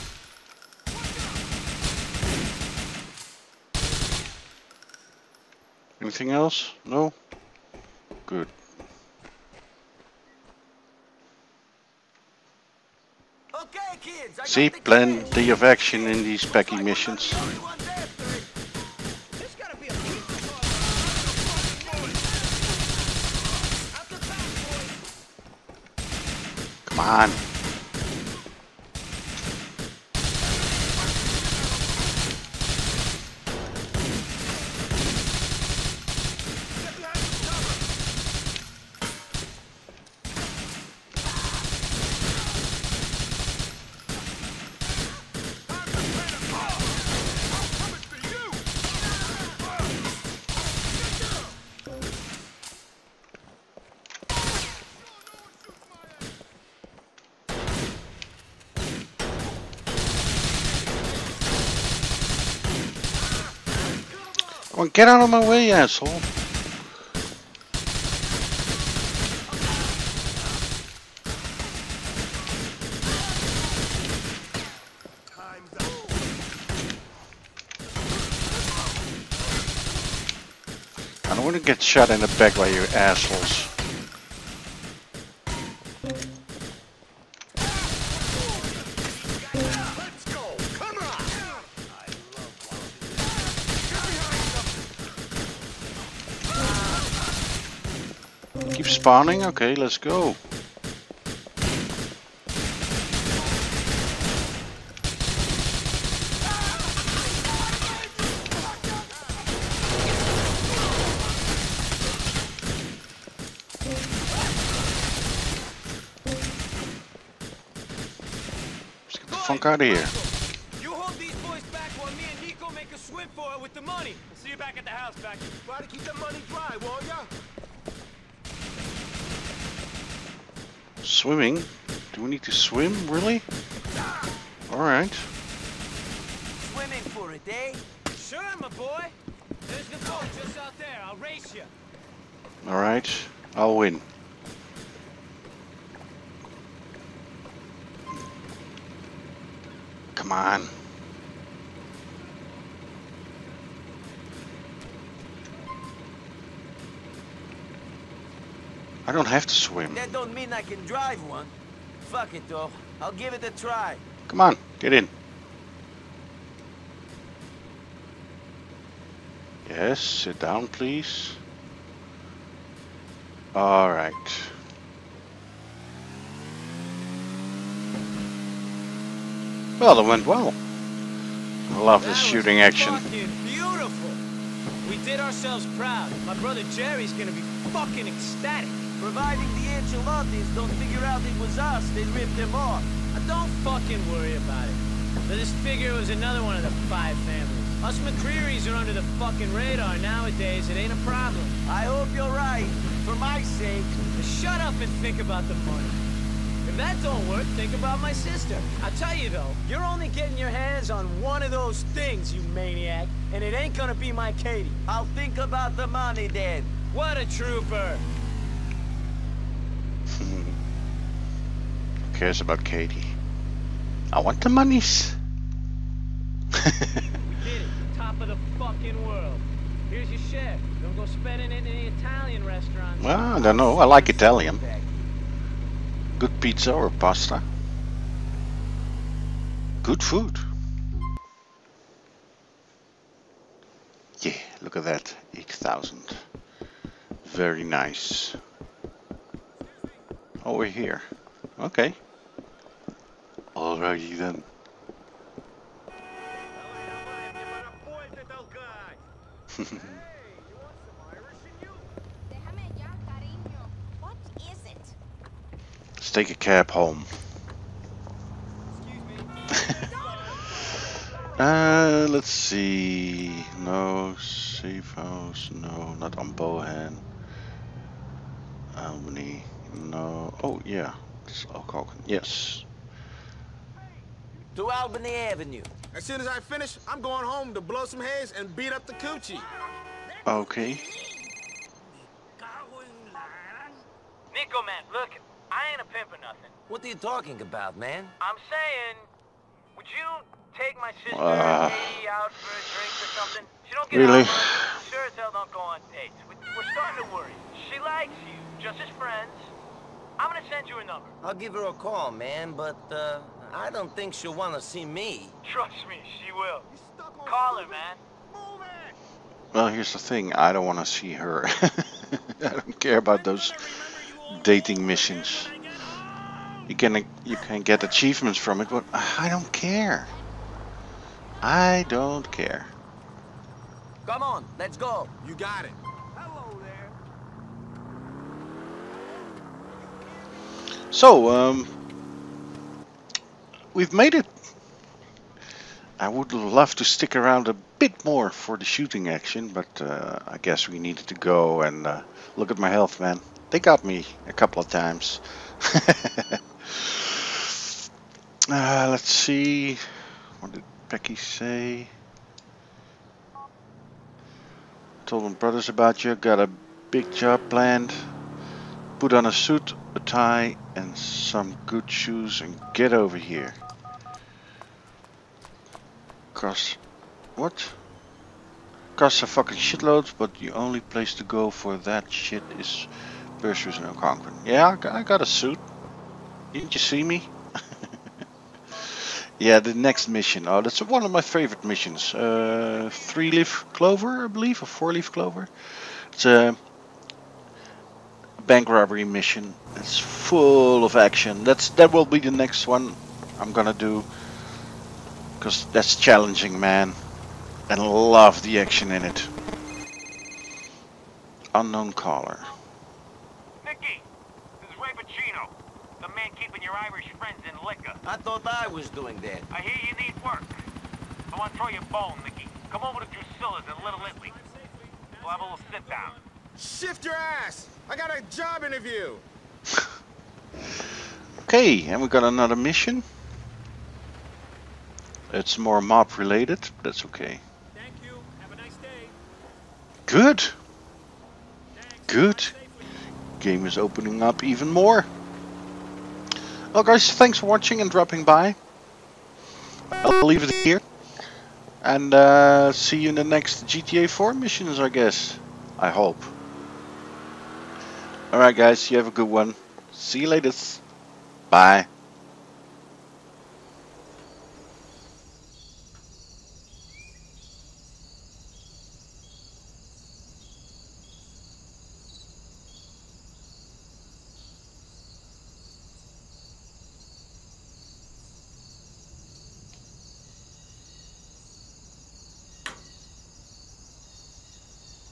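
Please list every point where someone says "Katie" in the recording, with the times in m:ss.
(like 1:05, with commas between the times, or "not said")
3:34, 3:42.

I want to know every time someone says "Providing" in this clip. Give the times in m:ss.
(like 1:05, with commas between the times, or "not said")
3:08.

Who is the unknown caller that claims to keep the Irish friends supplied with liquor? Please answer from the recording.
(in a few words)
Ray Boccino.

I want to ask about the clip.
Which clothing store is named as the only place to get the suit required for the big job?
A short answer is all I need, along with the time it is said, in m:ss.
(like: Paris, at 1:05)
Perseus, at 6:23.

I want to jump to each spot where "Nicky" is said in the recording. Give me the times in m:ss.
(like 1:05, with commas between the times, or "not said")
6:53, 7:02.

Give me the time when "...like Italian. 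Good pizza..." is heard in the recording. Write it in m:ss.
3:53.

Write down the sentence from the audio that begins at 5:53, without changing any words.
They got me a couple of times.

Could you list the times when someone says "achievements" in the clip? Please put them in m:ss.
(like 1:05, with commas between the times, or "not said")
5:27.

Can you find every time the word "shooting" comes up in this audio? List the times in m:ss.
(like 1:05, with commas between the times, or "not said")
3:02, 5:48.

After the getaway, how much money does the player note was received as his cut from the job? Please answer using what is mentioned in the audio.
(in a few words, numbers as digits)
8,000.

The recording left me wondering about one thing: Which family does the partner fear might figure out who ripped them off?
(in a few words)
The Ancelottis.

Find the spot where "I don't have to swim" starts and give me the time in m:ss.
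2:39.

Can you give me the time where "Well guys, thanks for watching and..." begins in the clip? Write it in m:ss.
7:26.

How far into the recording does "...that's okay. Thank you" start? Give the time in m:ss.
7:16.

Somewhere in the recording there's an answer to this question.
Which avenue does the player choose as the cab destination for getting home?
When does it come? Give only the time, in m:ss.
4:44.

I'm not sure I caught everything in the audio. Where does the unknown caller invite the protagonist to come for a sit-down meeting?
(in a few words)
Drusilla's.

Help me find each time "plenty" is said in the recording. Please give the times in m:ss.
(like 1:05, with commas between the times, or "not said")
0:14.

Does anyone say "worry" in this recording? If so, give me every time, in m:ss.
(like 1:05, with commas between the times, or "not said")
3:14, 5:07.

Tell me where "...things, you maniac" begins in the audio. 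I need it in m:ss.
3:31.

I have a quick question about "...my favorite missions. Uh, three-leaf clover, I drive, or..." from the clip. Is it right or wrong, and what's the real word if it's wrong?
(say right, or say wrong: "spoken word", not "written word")
wrong: "believe", not "drive".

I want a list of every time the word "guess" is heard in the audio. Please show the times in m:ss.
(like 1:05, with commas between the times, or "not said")
5:50, 7:34.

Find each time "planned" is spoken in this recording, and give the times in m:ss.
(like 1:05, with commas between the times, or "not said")
6:07.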